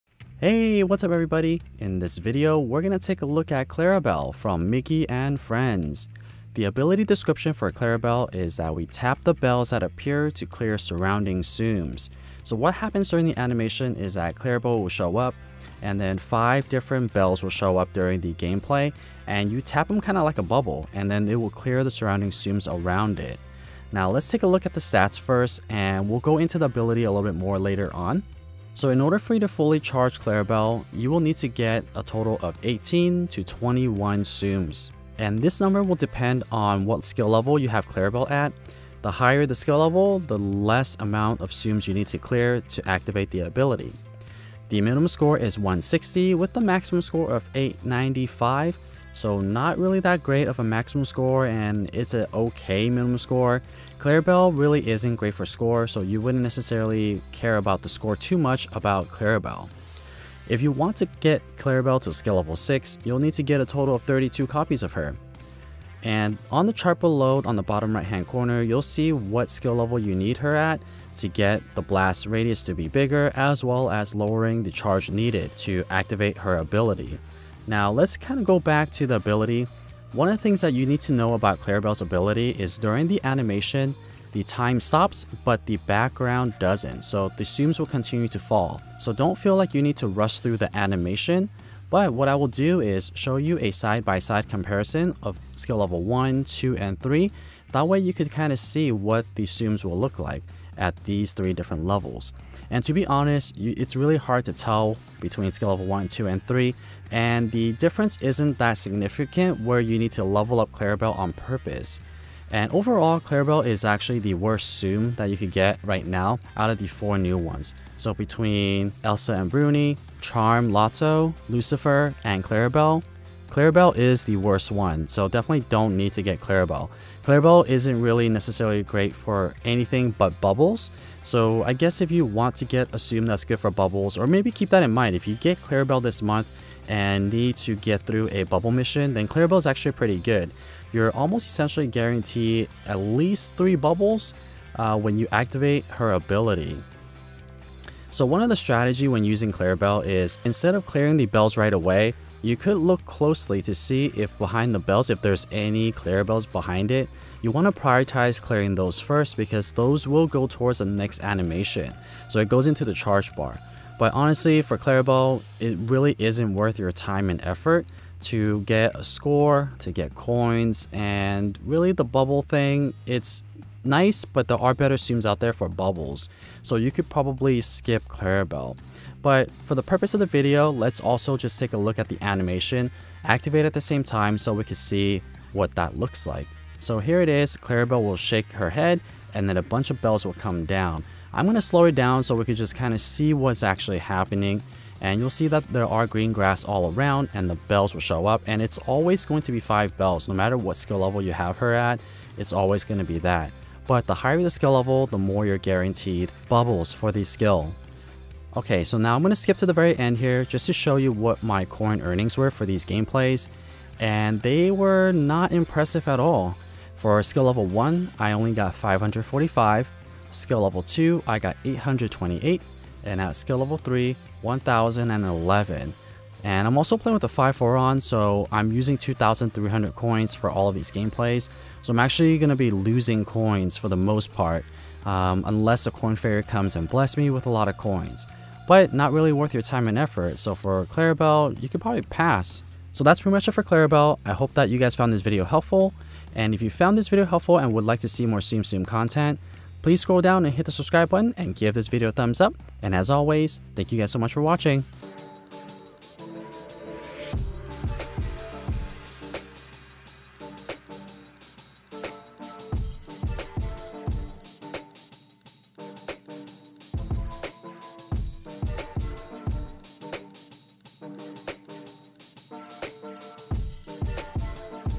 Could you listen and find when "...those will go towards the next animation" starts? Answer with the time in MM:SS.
02:39.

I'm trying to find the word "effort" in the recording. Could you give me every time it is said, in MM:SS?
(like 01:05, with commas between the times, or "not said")
02:47, 03:59.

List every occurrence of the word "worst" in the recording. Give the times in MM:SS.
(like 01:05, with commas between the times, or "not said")
01:54, 02:04.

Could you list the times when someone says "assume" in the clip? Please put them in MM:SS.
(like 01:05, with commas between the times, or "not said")
02:12, 02:54.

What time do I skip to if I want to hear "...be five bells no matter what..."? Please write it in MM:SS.
03:19.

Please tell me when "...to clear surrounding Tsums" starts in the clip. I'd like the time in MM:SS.
00:10.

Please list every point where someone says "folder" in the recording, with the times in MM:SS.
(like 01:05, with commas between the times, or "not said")
not said.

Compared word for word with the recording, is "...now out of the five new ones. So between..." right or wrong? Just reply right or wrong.
wrong.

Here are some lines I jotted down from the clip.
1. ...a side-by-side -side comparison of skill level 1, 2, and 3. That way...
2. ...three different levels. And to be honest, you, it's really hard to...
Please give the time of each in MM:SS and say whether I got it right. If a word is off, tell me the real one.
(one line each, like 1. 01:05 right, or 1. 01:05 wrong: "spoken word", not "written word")
1. 01:33 right
2. 01:41 right.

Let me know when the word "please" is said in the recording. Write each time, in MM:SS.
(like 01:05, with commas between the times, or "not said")
04:09.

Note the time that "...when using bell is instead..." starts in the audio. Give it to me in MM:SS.
02:29.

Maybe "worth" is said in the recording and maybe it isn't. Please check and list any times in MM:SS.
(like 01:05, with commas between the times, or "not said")
02:46, 03:59.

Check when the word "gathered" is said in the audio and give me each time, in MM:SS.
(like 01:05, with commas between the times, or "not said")
not said.